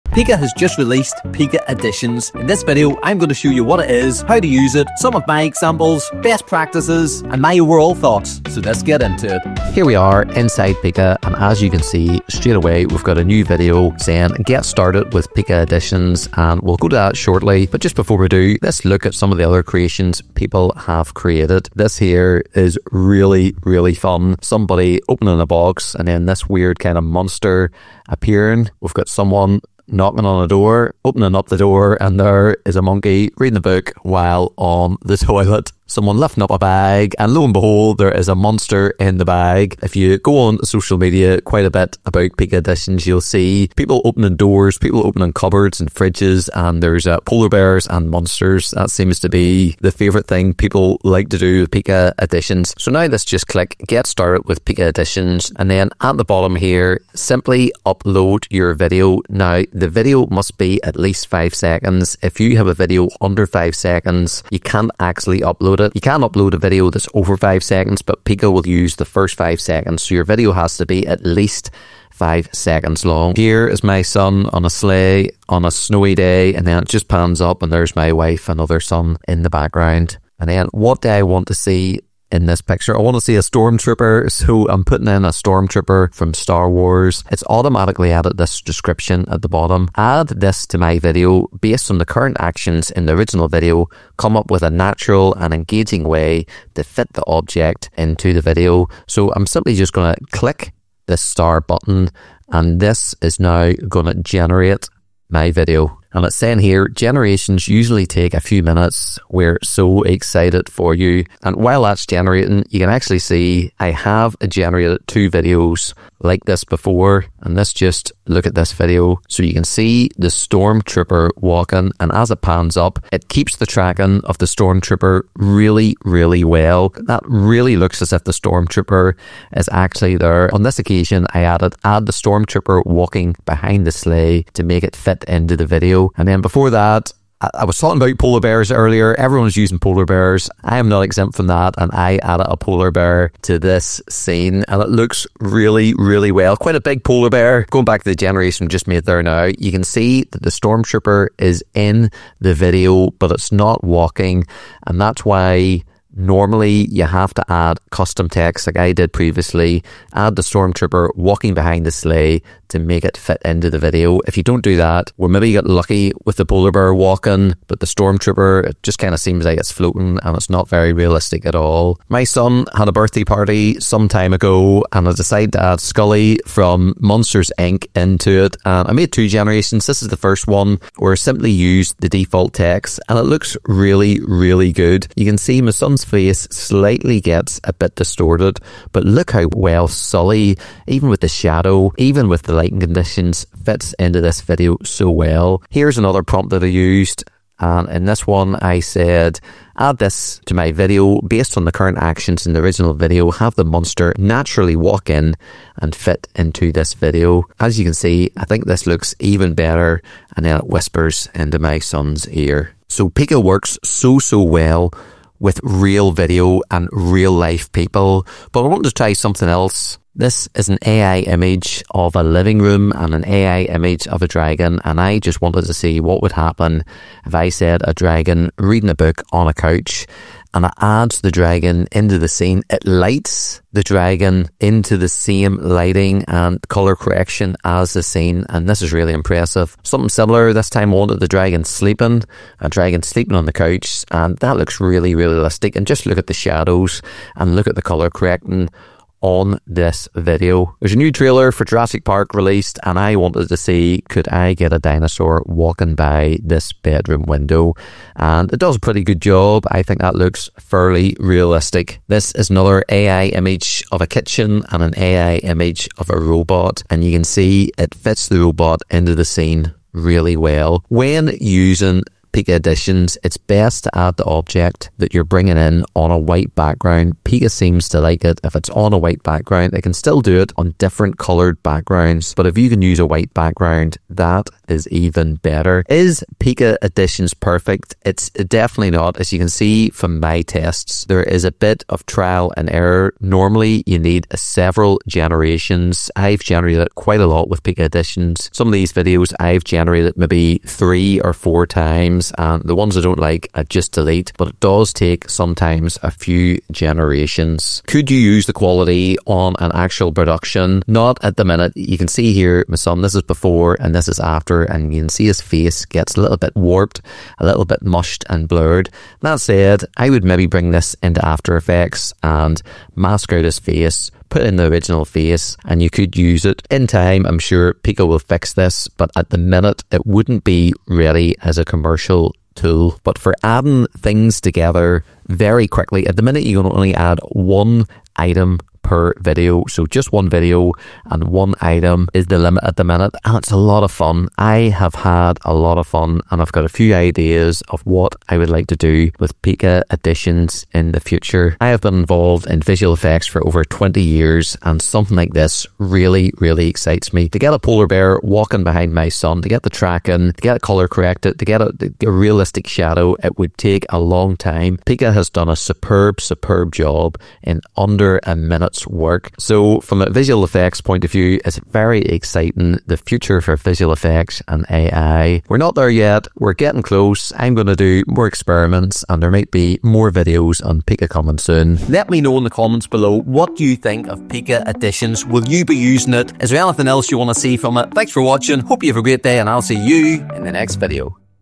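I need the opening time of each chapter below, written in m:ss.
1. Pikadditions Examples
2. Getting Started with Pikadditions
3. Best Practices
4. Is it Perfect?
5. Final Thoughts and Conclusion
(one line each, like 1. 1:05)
1. 0:18
2. 0:52
3. 4:30
4. 4:46
5. 5:08.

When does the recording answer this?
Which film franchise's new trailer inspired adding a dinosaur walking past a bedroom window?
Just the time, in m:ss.
4:11.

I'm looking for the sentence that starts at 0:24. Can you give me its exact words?
Somebody opening a box, and then this weird kind of monster appearing.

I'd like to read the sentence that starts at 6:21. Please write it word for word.
Let me know in the comments below what you think of Pikadditions.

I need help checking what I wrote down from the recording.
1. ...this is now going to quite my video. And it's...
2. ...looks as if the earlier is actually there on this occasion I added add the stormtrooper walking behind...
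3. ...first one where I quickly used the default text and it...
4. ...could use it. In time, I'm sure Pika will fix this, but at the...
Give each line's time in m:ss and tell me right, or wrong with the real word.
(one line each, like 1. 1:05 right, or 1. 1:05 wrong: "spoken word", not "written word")
1. 1:42 wrong: "generate", not "quite"
2. 2:07 wrong: "stormtrooper", not "earlier"
3. 3:00 wrong: "simply", not "quickly"
4. 5:25 right.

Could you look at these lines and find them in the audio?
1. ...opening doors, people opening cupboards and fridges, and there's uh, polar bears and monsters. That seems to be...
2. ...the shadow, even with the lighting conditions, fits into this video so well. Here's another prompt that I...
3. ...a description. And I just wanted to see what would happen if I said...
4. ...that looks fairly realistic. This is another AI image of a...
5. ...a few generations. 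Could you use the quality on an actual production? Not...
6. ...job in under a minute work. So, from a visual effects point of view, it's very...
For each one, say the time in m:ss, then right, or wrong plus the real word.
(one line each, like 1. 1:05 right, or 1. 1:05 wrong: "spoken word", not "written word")
1. 0:44 right
2. 3:11 right
3. 3:44 wrong: "dragon", not "description"
4. 4:20 right
5. 5:06 right
6. 6:06 right.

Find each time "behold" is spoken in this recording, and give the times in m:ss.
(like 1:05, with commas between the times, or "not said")
0:37.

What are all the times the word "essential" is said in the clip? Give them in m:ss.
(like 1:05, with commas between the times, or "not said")
5:32.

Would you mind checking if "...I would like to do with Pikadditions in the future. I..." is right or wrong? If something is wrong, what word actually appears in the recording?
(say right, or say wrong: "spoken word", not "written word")
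right.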